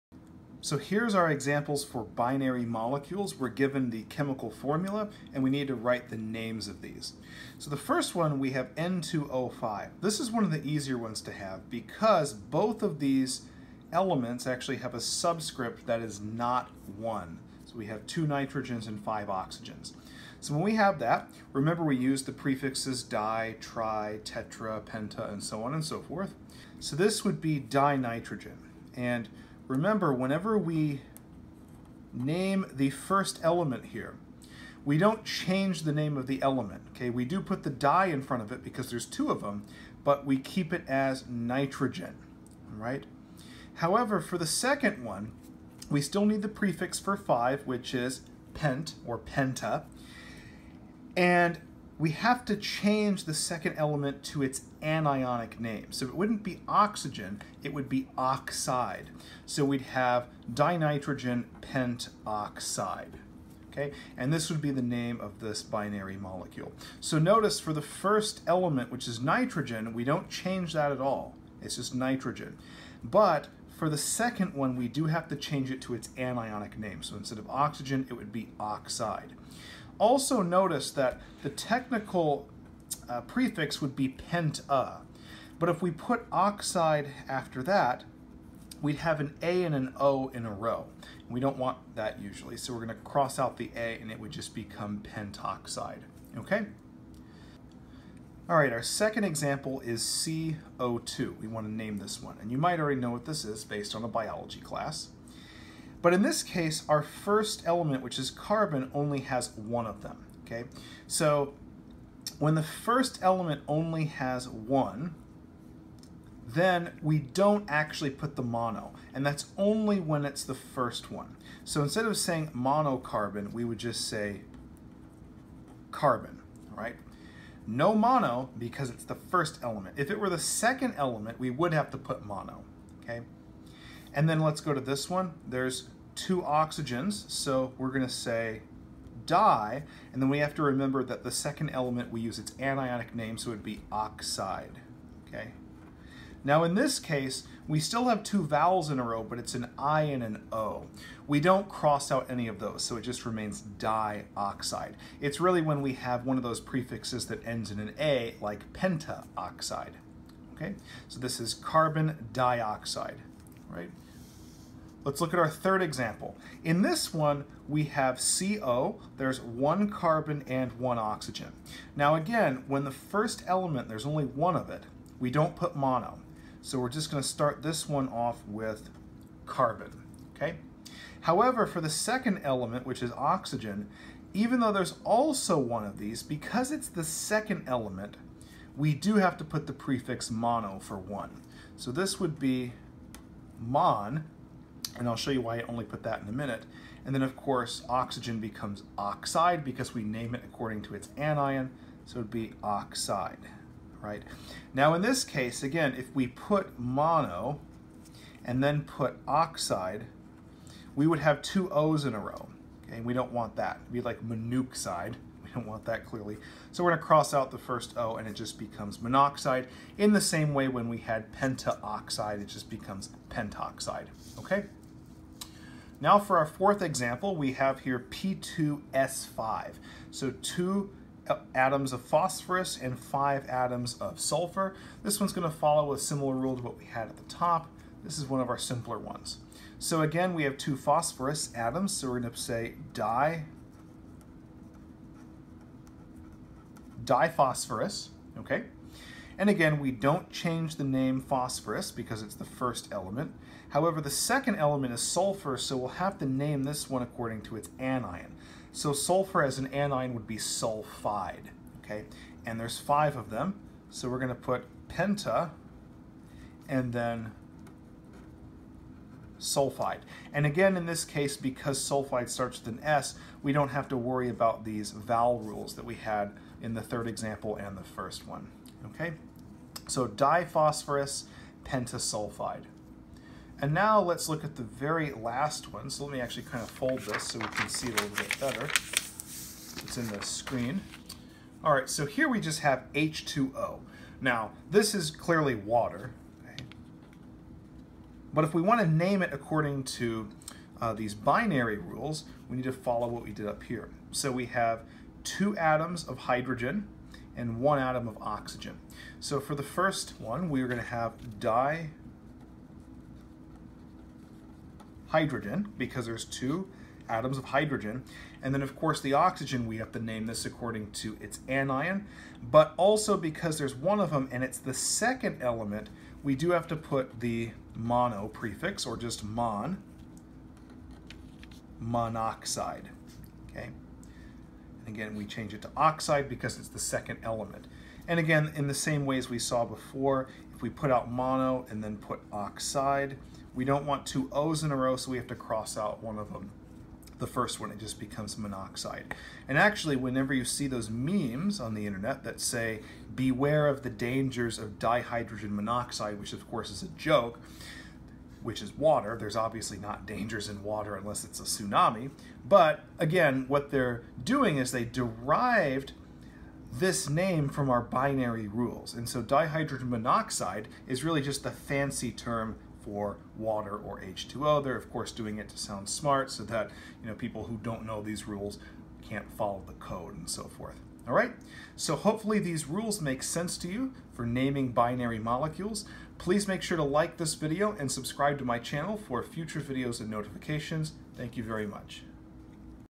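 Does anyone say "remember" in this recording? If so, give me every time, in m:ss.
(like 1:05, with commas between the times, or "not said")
0:21, 0:29, 2:20.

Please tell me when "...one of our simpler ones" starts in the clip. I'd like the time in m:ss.
3:58.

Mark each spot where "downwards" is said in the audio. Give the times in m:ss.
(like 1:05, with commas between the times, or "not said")
not said.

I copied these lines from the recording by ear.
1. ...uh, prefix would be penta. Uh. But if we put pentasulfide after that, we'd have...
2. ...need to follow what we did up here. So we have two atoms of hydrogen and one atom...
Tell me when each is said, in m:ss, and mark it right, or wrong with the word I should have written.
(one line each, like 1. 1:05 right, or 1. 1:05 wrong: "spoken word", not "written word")
1. 1:23 wrong: "oxide", not "pentasulfide"
2. 5:02 right.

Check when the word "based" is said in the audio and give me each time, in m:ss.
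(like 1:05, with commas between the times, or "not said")
1:43.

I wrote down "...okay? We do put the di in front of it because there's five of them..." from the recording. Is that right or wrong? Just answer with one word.
wrong.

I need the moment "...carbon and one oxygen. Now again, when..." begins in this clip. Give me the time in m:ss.
2:49.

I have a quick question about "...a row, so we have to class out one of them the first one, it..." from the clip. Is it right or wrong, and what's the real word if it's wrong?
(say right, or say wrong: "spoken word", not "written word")
wrong: "cross", not "class".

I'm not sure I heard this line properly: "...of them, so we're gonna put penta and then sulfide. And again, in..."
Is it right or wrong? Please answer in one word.
right.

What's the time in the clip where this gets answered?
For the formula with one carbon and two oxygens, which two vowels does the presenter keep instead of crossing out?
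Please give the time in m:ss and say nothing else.
2:29.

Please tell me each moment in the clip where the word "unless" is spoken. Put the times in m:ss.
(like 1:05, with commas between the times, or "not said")
6:00.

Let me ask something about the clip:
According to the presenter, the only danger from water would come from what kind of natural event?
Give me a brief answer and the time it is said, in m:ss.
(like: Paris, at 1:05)
a tsunami, at 6:01.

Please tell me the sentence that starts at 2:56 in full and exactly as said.
So we're just gonna start this one off with carbon, okay?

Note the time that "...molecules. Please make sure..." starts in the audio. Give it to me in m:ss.
6:25.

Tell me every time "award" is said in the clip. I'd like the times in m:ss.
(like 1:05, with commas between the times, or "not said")
not said.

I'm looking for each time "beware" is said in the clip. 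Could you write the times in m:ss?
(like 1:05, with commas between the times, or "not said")
5:53.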